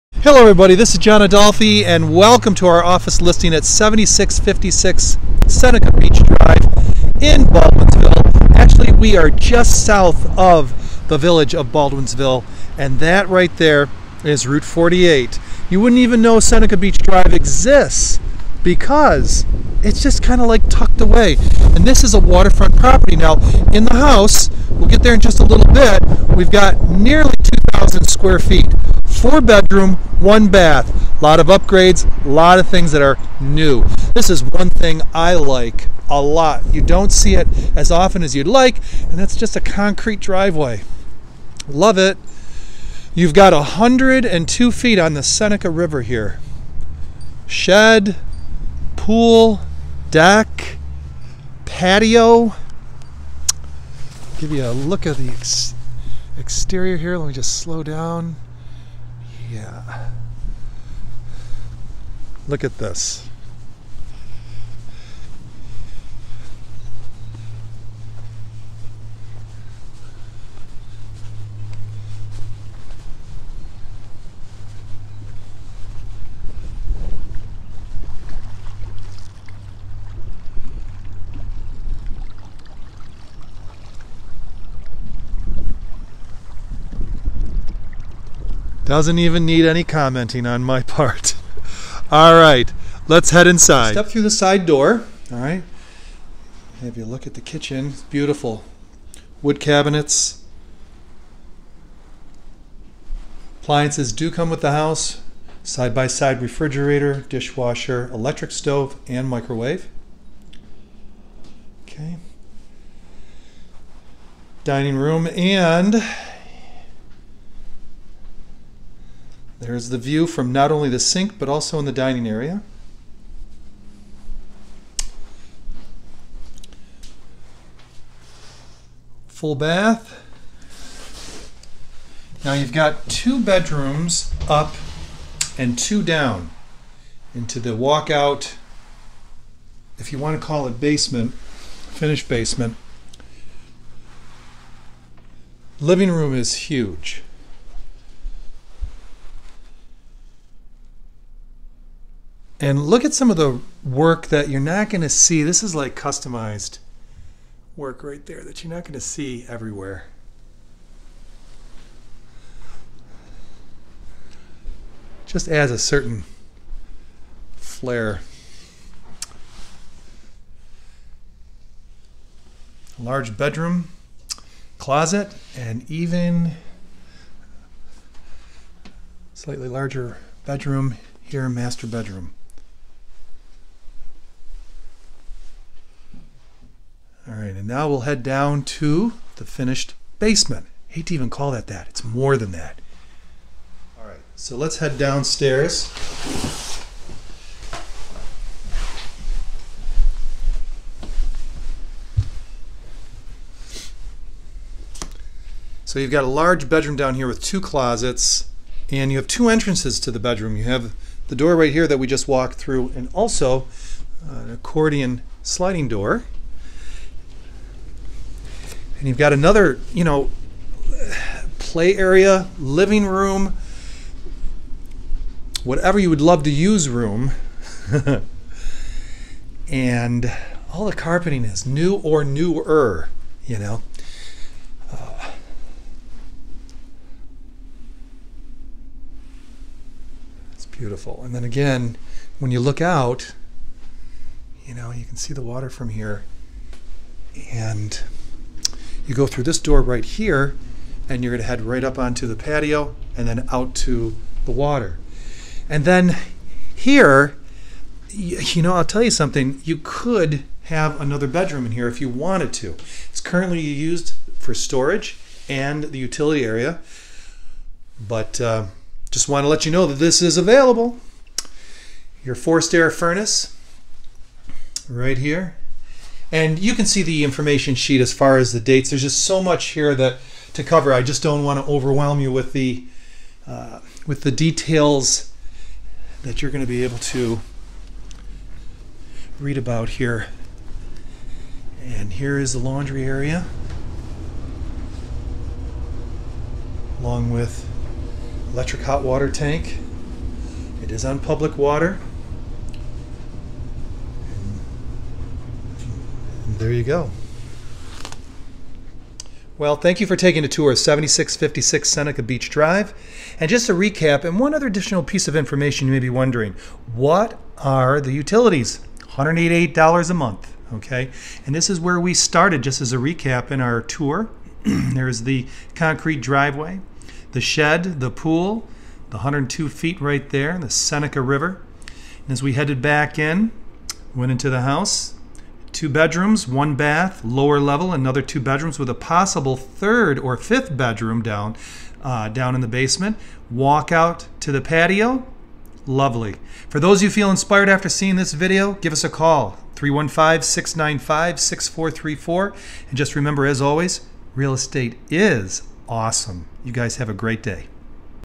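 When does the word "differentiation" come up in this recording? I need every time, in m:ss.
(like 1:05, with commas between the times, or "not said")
not said.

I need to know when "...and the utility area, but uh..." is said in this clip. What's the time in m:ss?
4:25.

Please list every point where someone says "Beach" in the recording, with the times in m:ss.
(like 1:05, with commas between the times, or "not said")
0:05, 0:16, 5:12.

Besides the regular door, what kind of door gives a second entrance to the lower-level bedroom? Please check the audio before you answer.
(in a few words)
Accordion sliding door.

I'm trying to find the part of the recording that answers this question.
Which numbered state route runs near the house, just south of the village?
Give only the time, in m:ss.
0:14.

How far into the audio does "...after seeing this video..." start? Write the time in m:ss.
5:47.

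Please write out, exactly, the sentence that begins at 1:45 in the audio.
Side by side refrigerator, dishwasher, electric stove, and microwave.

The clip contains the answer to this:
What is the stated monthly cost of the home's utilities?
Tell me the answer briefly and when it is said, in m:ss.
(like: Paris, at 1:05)
$188, at 5:19.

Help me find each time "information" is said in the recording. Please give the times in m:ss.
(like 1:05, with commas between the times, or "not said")
4:37, 5:15.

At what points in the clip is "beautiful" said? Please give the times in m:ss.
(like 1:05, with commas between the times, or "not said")
1:38, 4:00.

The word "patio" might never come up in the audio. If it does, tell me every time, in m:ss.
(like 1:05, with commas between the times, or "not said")
0:51, 4:12, 5:44.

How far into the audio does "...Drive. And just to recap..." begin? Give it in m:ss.
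5:12.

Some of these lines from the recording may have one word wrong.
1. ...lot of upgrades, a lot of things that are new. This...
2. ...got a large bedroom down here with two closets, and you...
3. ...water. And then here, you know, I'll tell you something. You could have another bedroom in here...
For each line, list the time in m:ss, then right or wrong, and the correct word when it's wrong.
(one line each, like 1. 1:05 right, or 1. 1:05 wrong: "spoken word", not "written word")
1. 0:31 right
2. 3:26 right
3. 4:14 right.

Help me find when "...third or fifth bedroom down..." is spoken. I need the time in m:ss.
5:39.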